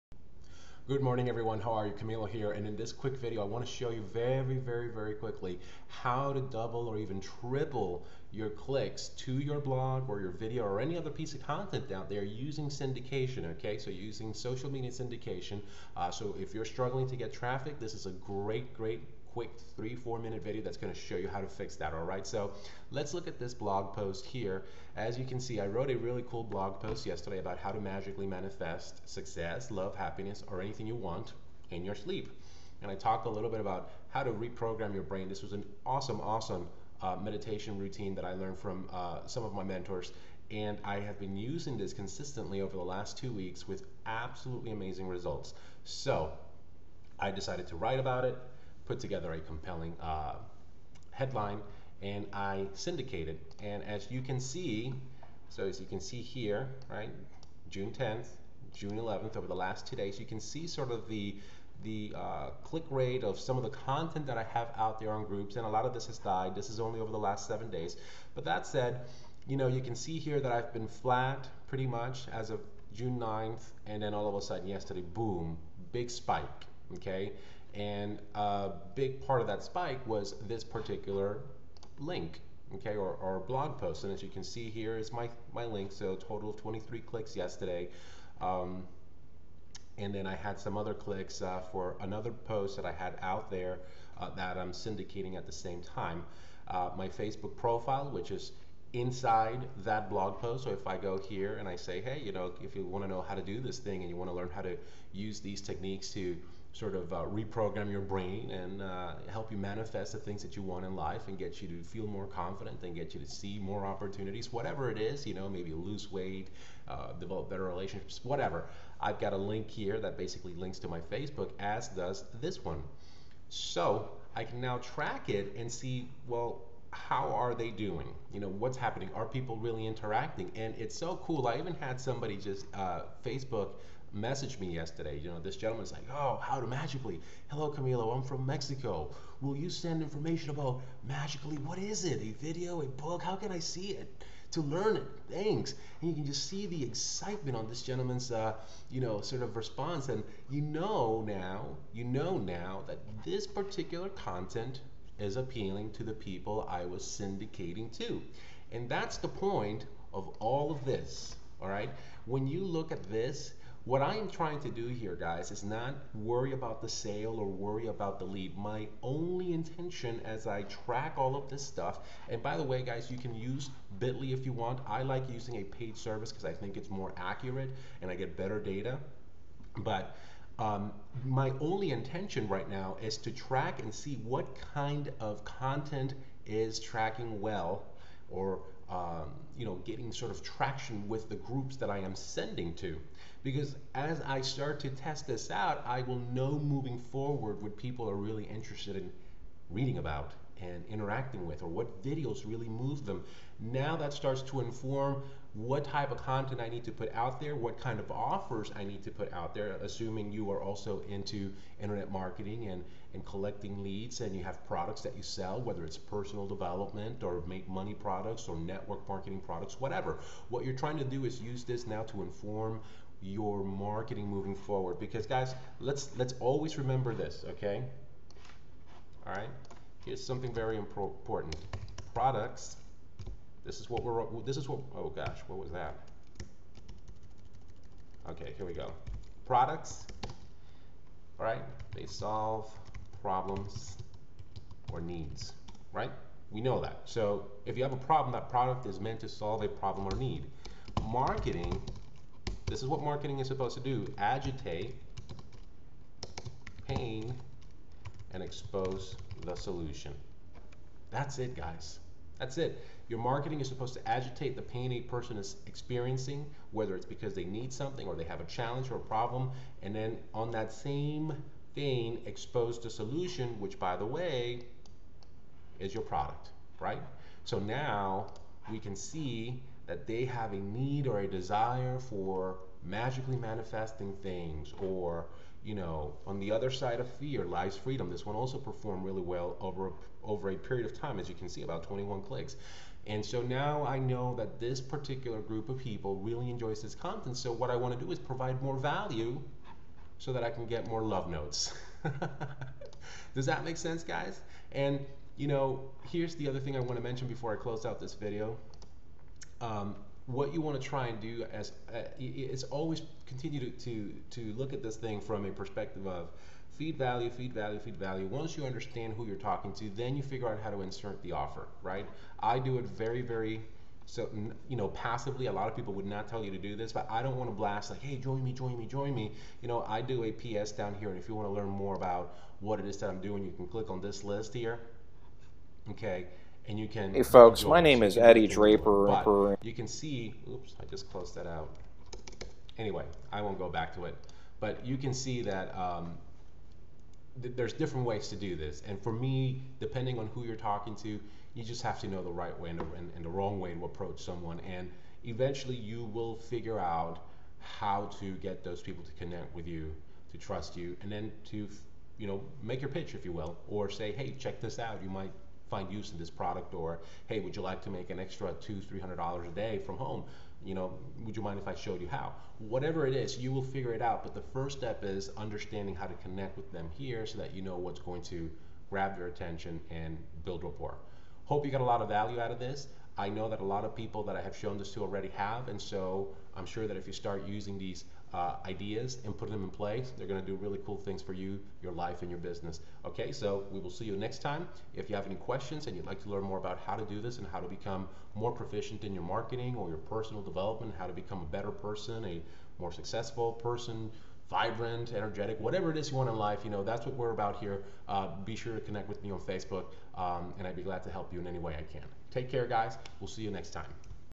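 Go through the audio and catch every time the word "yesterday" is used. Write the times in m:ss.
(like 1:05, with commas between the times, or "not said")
0:27, 1:14, 1:27, 2:14.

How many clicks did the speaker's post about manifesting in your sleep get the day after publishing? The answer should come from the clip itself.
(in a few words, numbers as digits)
23.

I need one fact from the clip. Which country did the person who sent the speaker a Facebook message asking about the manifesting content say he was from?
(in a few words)
Mexico.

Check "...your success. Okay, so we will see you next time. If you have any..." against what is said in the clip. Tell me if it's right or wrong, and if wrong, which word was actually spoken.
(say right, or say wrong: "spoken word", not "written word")
wrong: "business", not "success".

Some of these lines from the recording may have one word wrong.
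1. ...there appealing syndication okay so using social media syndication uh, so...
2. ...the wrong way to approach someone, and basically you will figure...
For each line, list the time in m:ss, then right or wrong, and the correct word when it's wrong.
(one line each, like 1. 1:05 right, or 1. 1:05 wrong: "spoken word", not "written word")
1. 0:12 wrong: "using", not "appealing"
2. 5:53 wrong: "eventually", not "basically".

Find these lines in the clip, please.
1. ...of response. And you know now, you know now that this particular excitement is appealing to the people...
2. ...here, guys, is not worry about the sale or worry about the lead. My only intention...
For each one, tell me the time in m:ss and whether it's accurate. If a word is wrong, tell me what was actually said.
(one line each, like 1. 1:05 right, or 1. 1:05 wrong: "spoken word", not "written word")
1. 2:29 wrong: "content", not "excitement"
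2. 2:44 right.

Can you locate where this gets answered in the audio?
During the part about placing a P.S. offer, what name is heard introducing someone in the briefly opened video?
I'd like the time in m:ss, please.
5:38.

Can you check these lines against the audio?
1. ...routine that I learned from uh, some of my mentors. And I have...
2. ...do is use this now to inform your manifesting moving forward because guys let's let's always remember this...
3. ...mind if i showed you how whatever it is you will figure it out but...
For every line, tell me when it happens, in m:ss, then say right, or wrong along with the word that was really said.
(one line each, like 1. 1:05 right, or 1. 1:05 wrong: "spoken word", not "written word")
1. 0:37 right
2. 3:41 wrong: "marketing", not "manifesting"
3. 6:11 right.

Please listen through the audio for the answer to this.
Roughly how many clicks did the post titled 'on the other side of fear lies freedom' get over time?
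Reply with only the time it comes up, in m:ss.
4:51.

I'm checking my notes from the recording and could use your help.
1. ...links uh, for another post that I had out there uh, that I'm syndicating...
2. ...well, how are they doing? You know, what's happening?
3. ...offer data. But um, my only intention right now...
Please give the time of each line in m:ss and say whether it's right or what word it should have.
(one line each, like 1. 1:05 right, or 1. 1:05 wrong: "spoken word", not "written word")
1. 1:30 wrong: "clicks", not "links"
2. 2:06 right
3. 2:58 wrong: "better", not "offer".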